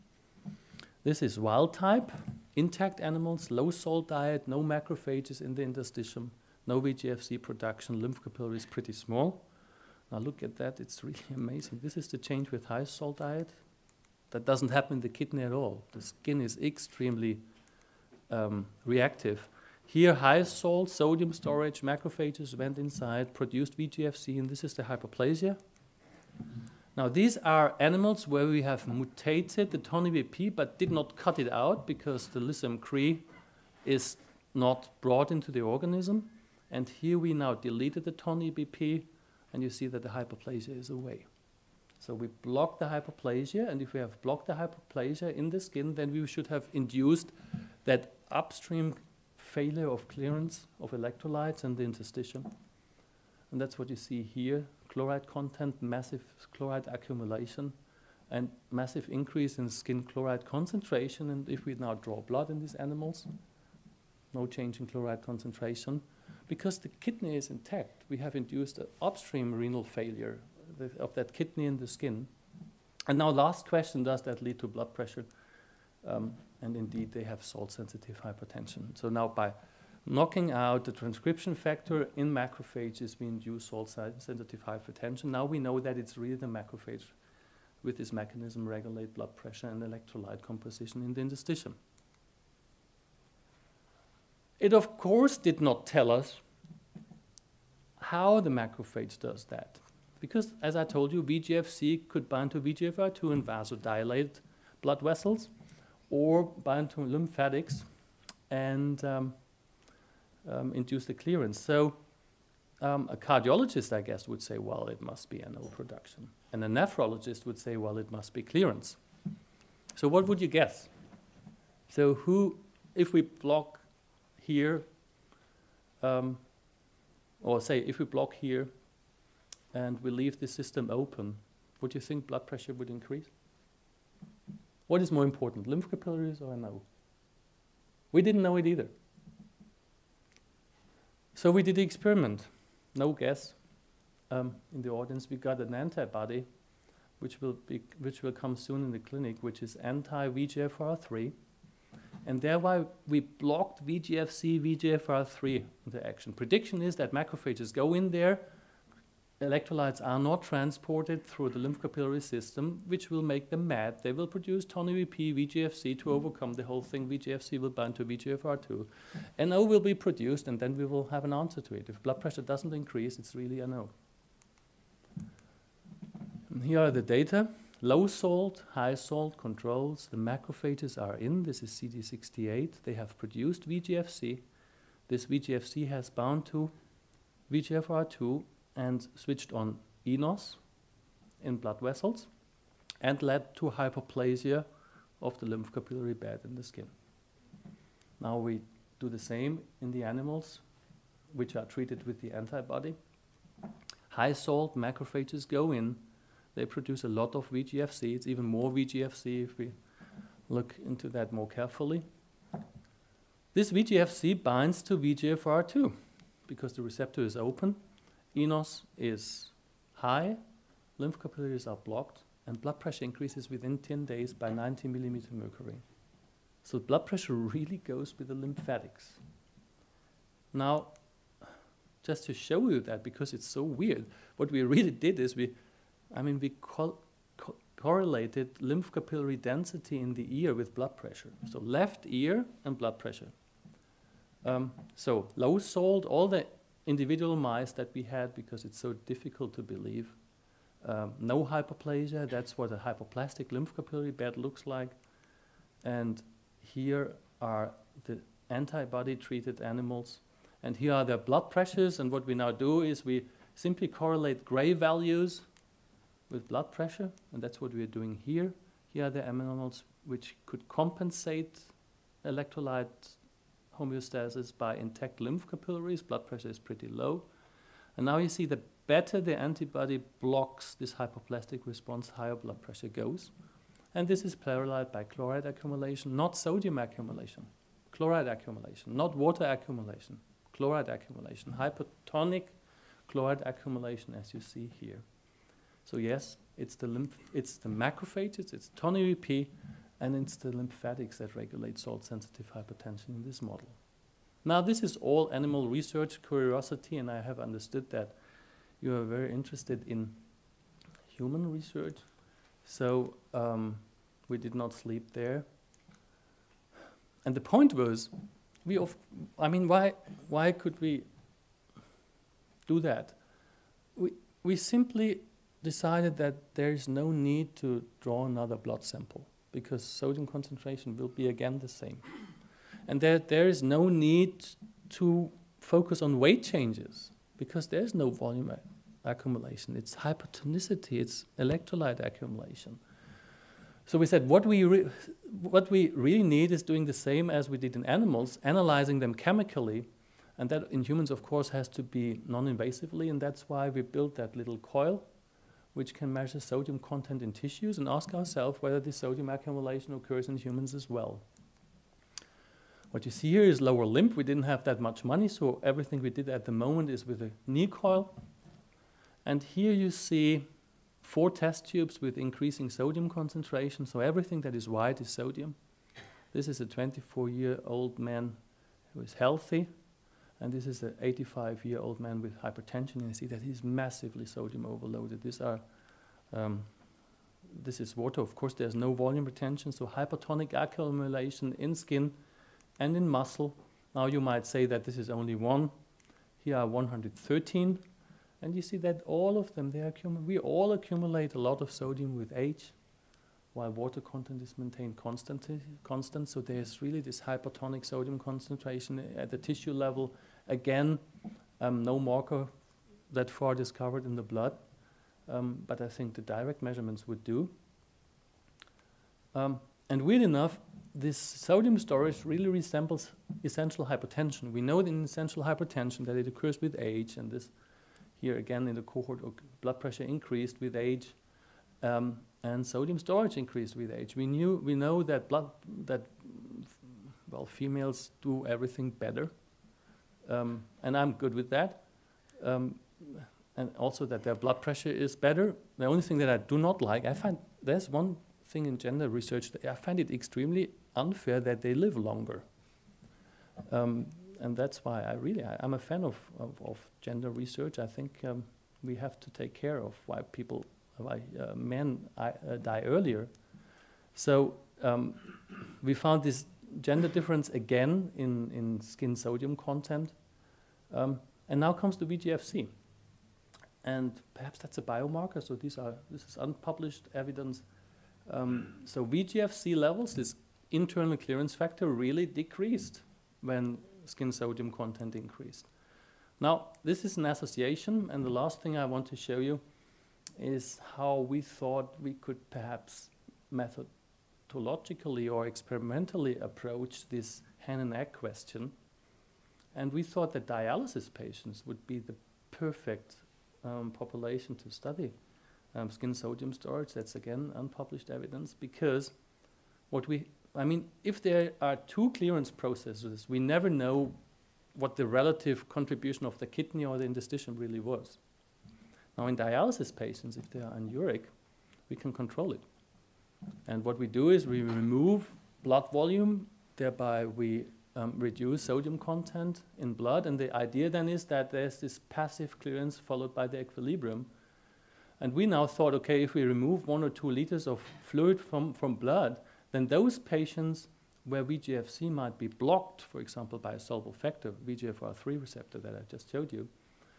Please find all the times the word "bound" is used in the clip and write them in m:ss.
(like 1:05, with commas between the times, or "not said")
3:06.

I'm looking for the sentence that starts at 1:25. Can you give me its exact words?
Now we know that it's really the macrophage with this mechanism regulate blood pressure and electrolyte composition in the interstitium.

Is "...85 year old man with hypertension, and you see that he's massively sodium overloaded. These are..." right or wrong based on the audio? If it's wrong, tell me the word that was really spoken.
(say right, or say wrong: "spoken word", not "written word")
right.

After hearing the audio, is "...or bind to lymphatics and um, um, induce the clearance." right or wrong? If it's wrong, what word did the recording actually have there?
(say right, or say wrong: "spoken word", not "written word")
right.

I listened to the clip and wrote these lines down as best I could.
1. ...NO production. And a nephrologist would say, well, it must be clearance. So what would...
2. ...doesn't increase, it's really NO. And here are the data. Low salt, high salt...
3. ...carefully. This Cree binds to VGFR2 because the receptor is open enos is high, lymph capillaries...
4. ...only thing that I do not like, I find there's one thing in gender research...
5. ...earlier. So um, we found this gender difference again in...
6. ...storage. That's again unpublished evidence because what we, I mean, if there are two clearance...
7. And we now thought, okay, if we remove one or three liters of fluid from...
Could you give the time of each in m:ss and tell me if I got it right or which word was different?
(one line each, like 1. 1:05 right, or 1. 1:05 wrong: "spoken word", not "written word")
1. 1:55 right
2. 2:52 right
3. 3:31 wrong: "VGFC", not "Cree"
4. 7:25 right
5. 7:42 right
6. 8:26 right
7. 8:55 wrong: "two", not "three".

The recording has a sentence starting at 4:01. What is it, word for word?
So left ear and blood pressure.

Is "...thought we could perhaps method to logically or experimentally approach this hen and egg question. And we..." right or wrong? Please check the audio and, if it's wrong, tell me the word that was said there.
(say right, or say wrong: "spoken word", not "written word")
right.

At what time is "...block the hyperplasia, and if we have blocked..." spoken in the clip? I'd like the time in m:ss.
0:42.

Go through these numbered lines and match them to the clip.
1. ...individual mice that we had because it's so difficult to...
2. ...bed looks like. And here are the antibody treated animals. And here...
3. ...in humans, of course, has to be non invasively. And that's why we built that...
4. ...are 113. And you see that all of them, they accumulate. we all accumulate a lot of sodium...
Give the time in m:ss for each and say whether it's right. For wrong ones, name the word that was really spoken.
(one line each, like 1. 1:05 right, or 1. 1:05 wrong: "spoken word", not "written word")
1. 4:06 right
2. 4:14 right
3. 5:50 right
4. 6:36 right.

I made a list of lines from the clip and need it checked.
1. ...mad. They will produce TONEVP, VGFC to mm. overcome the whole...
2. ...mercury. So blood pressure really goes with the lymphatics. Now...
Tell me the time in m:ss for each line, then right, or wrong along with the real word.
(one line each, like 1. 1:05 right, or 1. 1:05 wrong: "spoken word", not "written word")
1. 2:43 right
2. 3:45 right.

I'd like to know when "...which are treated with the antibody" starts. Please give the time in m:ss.
3:21.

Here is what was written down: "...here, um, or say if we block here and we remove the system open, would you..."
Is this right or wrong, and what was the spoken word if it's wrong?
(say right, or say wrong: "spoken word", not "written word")
wrong: "leave", not "remove".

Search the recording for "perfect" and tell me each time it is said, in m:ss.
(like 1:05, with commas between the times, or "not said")
8:22.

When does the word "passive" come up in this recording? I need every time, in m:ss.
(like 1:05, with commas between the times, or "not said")
8:52.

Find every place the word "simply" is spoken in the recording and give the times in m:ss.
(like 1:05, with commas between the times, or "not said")
4:23, 5:24.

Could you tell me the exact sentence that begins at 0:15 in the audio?
The skin is extremely um, reactive.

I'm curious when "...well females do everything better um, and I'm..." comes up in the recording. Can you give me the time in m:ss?
7:17.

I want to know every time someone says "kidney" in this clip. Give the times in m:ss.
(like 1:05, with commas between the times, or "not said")
0:15, 1:07, 1:11, 8:36.